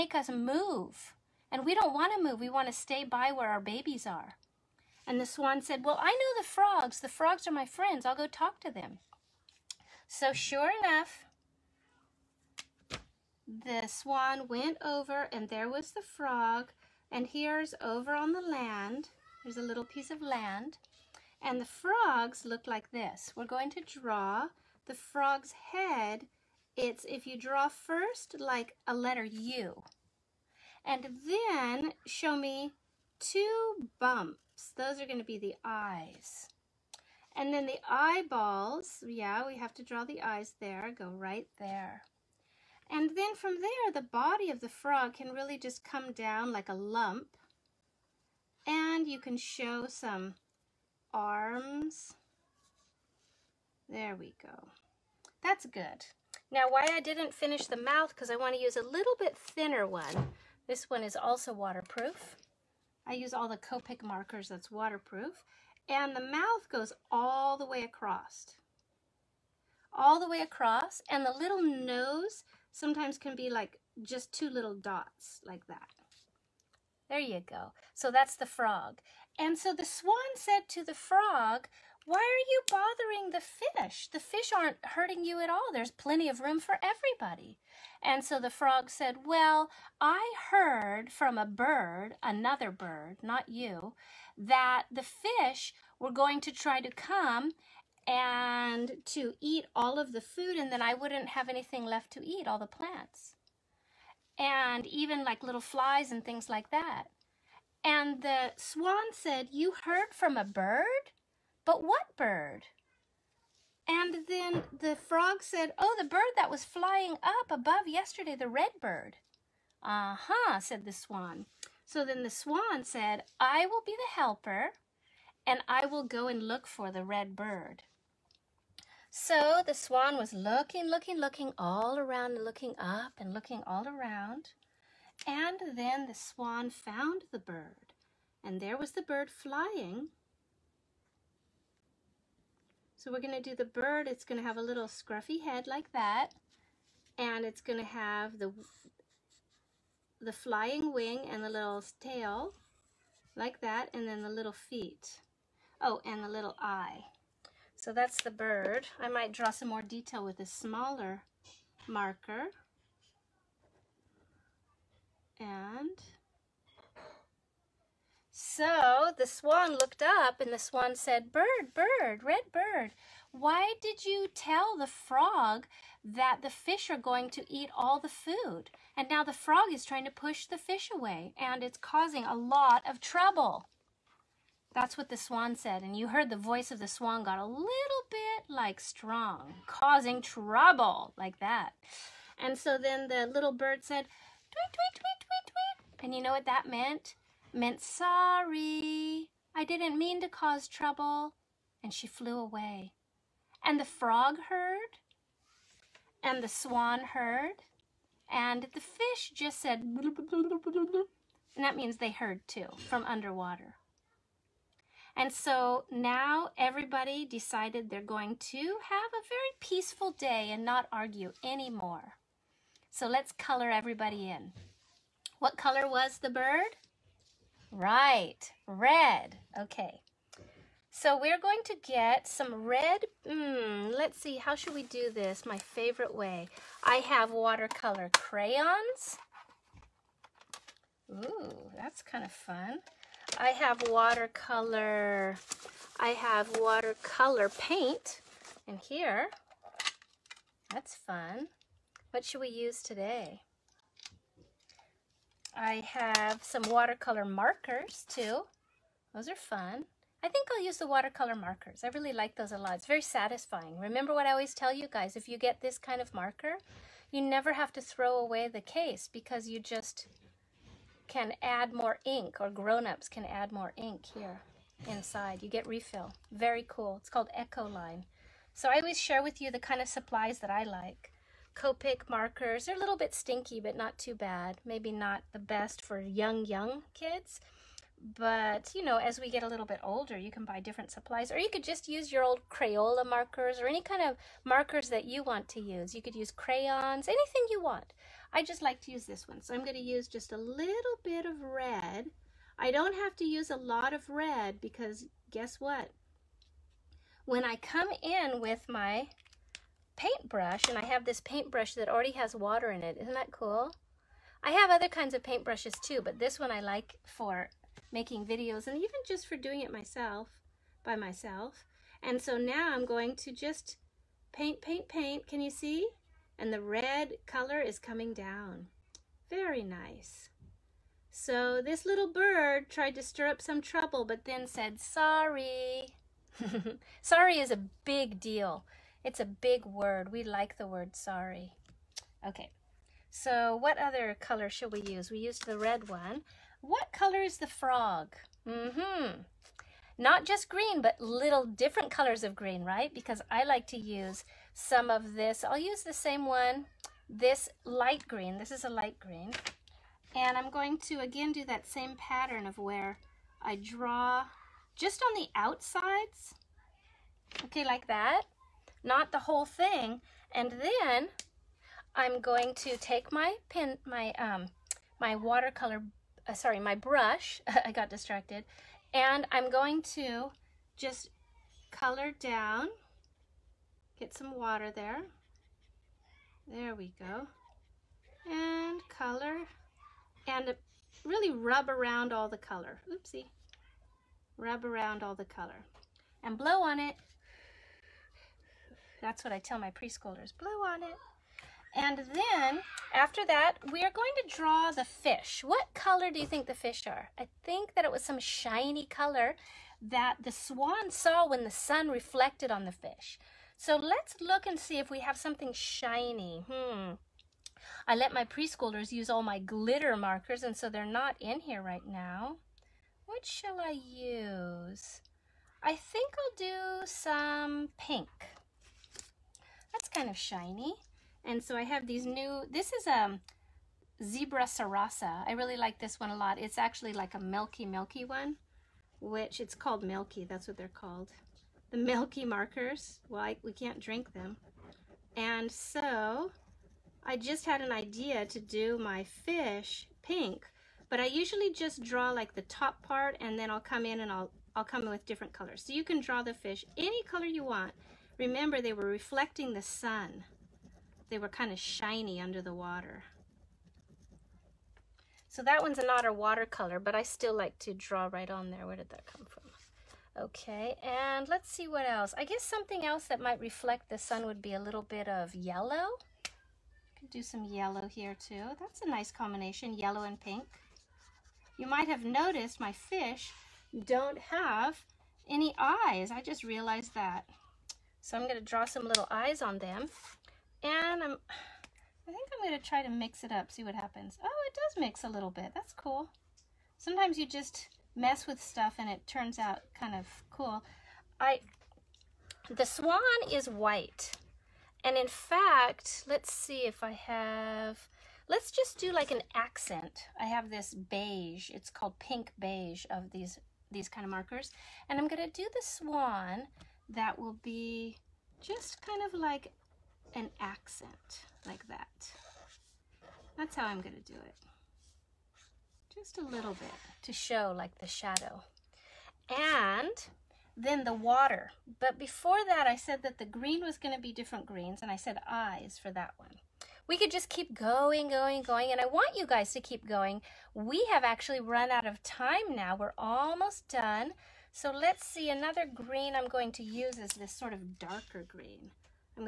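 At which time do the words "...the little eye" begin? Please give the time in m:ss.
2:36.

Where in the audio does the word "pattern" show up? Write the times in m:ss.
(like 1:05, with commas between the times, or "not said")
6:01.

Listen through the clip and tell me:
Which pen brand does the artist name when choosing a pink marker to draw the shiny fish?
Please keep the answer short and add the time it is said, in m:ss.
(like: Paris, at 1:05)
Zebra Sarasa, at 7:14.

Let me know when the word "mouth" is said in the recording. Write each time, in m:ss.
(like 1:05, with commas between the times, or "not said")
0:57, 1:06.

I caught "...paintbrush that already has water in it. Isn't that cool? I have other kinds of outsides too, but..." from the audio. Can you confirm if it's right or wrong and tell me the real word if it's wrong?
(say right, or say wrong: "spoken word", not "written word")
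wrong: "paintbrushes", not "outsides".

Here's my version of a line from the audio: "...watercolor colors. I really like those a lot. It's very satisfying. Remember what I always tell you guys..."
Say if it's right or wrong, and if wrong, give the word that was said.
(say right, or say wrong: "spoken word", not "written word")
wrong: "markers", not "colors".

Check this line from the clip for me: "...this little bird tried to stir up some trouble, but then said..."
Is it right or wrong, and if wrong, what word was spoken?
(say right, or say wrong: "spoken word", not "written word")
right.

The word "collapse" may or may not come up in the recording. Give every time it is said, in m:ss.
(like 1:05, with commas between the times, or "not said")
not said.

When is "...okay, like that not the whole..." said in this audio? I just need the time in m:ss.
6:07.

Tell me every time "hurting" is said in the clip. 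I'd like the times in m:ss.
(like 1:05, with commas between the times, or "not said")
1:24.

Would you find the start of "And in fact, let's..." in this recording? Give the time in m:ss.
8:24.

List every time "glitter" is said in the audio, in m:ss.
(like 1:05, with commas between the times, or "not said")
6:59.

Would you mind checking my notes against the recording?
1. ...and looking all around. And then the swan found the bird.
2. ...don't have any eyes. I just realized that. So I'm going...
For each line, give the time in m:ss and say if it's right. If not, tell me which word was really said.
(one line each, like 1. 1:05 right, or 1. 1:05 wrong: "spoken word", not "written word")
1. 2:13 right
2. 8:03 right.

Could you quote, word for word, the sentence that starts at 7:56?
Could do some yellow here too.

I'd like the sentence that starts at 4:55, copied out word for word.
You could use crayons, anything you want.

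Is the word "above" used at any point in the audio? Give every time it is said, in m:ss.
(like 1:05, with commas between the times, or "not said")
1:57.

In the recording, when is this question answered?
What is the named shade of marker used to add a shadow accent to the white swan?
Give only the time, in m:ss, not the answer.
8:31.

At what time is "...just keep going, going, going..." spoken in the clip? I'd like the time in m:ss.
8:57.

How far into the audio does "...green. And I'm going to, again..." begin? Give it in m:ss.
5:58.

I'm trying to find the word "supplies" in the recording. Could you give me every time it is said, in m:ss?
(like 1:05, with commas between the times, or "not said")
4:39, 4:50.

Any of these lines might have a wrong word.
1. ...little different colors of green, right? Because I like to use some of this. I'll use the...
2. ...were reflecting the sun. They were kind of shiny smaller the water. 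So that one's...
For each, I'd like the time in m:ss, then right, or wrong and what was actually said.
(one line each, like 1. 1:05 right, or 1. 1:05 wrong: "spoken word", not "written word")
1. 5:50 right
2. 7:38 wrong: "under", not "smaller".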